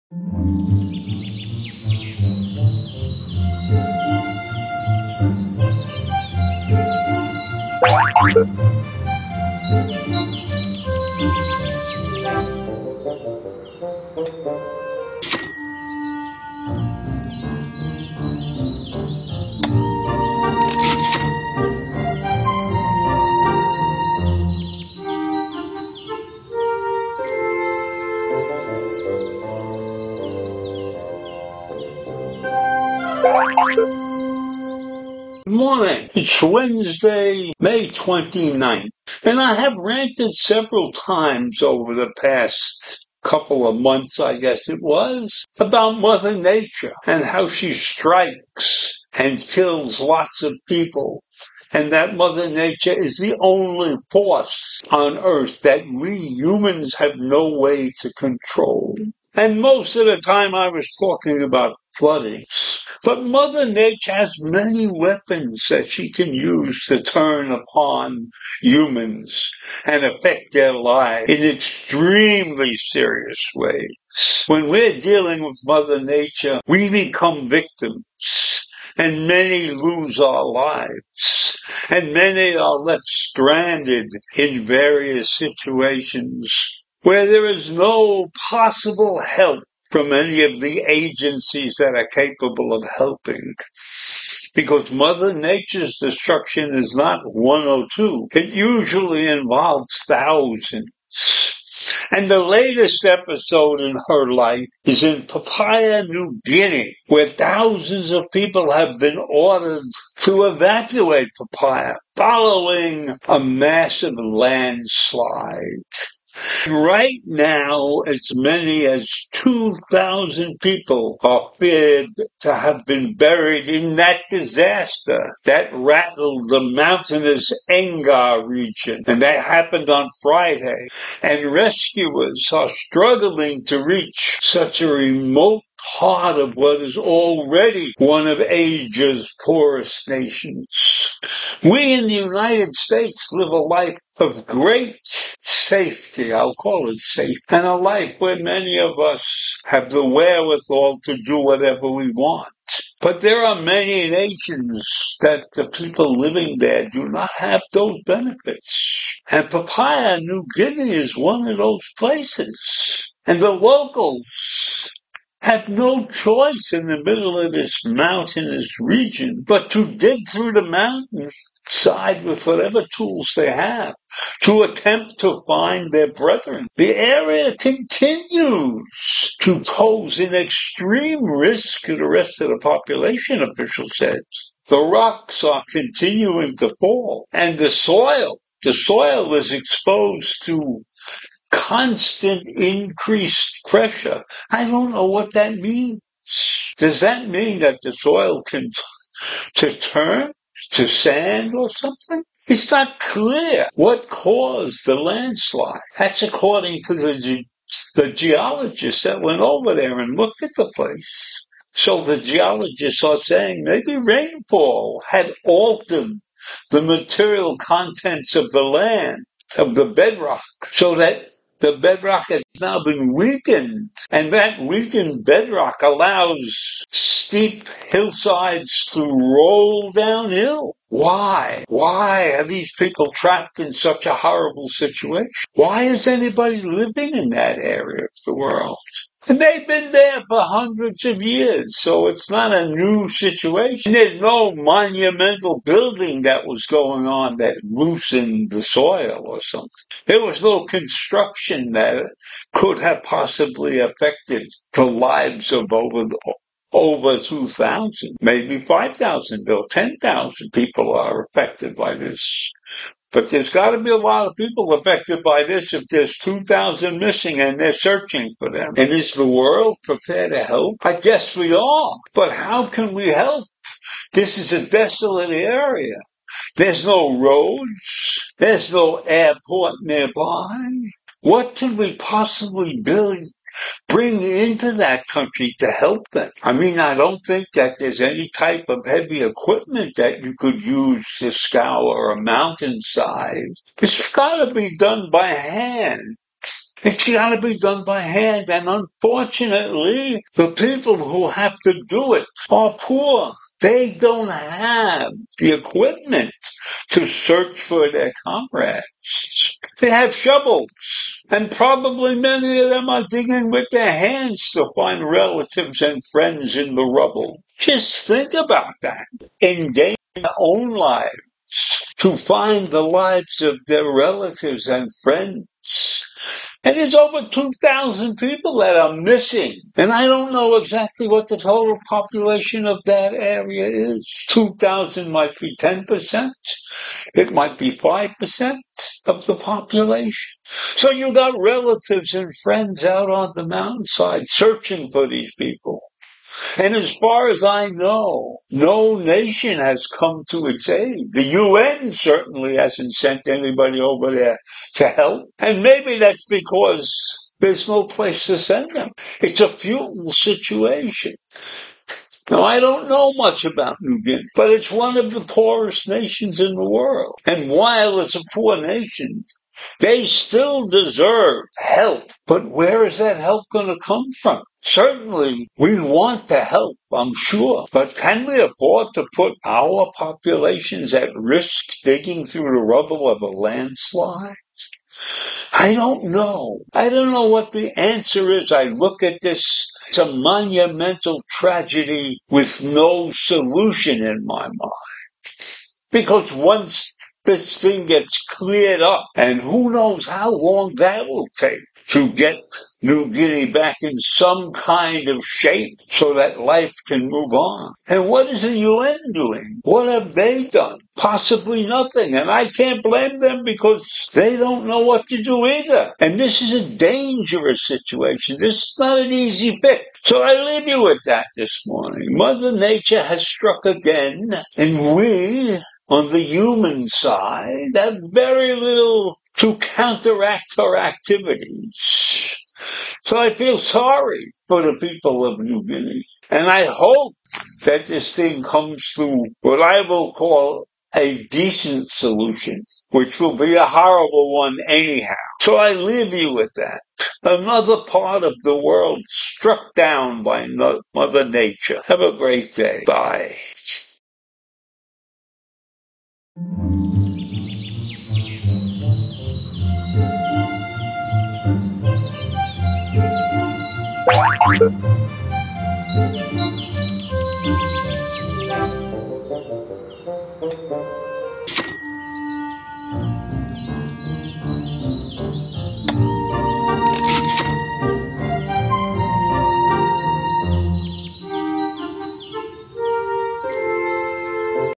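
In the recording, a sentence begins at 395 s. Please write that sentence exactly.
Because once this thing gets cleared up.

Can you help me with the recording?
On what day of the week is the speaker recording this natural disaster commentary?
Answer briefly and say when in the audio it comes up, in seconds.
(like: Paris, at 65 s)
Wednesday, at 36 s.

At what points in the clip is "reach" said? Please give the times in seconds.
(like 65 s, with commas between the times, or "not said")
133 s.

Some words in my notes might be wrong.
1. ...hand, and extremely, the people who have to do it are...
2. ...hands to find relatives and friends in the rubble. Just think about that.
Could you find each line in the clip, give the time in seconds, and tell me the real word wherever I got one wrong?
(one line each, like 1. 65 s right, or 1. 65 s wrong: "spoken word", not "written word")
1. 297 s wrong: "unfortunately", not "extremely"
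2. 313 s right.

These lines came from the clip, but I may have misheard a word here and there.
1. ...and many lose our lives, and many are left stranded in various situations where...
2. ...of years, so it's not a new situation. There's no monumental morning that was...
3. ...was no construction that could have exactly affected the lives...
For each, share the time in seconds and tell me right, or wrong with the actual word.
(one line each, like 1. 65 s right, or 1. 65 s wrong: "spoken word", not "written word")
1. 78 s right
2. 241 s wrong: "building", not "morning"
3. 250 s wrong: "possibly", not "exactly".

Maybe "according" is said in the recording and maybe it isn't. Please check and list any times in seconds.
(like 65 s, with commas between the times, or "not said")
206 s.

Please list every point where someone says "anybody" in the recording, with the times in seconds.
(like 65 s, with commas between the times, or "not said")
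236 s, 353 s.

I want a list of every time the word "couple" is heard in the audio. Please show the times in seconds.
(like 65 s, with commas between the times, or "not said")
43 s.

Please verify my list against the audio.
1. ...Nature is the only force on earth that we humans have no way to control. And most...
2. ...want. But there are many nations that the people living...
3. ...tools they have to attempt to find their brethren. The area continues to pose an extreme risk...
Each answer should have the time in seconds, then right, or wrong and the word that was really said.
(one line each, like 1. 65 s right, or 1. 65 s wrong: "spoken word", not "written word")
1. 52 s right
2. 152 s right
3. 172 s right.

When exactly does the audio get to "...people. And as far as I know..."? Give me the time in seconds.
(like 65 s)
345 s.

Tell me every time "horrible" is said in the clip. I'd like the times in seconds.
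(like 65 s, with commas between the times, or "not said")
234 s, 443 s.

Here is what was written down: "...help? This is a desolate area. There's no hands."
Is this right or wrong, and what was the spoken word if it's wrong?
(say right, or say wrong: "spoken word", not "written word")
wrong: "roads", not "hands".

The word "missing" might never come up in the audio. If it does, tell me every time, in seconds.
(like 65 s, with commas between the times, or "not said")
266 s, 328 s.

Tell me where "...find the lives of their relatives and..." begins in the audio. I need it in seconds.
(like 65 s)
322 s.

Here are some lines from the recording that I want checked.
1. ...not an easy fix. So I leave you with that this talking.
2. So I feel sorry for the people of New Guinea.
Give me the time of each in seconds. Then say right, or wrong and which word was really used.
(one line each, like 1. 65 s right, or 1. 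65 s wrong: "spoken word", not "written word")
1. 418 s wrong: "morning", not "talking"
2. 433 s right.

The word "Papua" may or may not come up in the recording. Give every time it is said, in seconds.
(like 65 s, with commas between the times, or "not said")
105 s, 111 s, 159 s.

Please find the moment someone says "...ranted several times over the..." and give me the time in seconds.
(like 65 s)
39 s.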